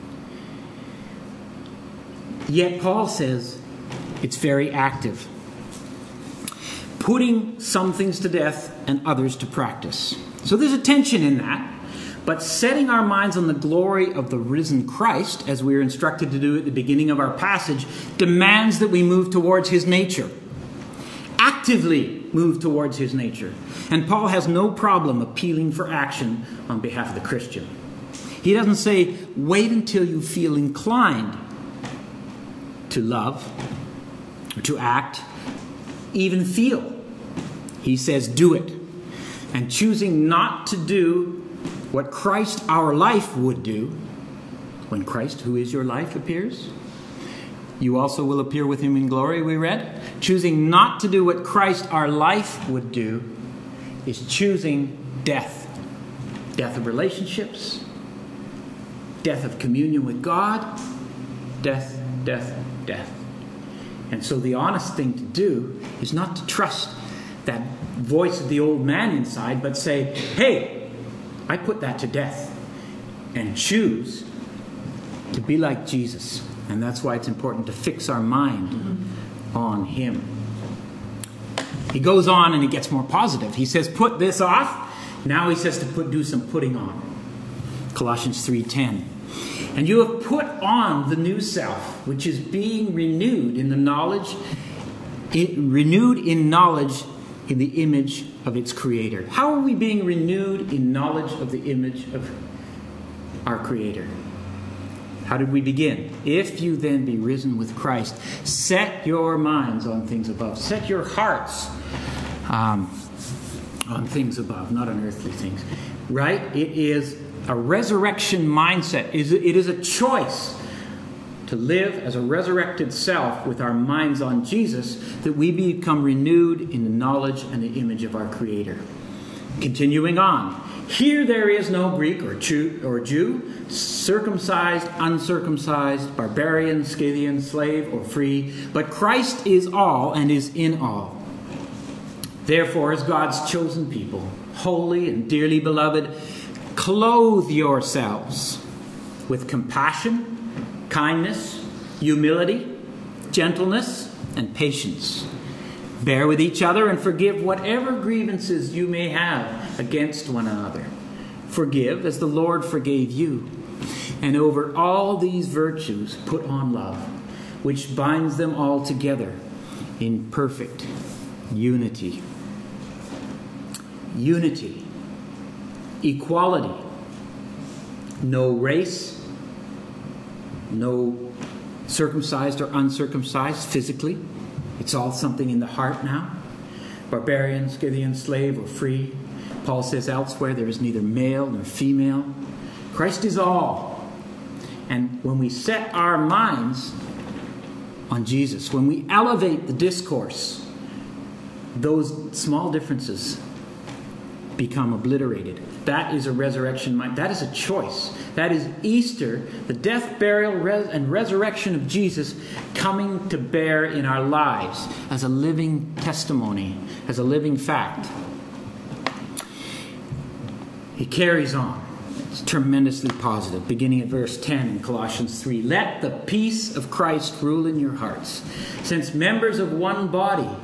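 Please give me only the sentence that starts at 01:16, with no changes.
And that's why it's important to fix our mind on Him.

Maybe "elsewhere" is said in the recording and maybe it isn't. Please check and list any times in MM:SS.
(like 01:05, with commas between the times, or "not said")
03:10.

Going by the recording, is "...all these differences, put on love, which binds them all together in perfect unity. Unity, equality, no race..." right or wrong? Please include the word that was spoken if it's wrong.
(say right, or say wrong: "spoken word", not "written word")
wrong: "virtues", not "differences".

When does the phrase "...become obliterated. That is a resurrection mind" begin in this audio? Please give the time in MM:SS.
03:24.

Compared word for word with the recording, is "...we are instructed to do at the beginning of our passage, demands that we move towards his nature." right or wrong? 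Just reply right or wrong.
right.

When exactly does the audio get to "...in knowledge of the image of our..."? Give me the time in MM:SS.
01:40.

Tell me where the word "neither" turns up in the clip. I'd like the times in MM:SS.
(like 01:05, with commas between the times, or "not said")
03:10.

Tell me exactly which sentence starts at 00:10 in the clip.
So there's a tension in that.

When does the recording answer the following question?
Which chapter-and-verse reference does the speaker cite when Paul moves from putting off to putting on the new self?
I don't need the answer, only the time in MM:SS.
01:27.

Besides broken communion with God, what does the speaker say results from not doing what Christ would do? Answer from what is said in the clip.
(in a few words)
Death of relationships.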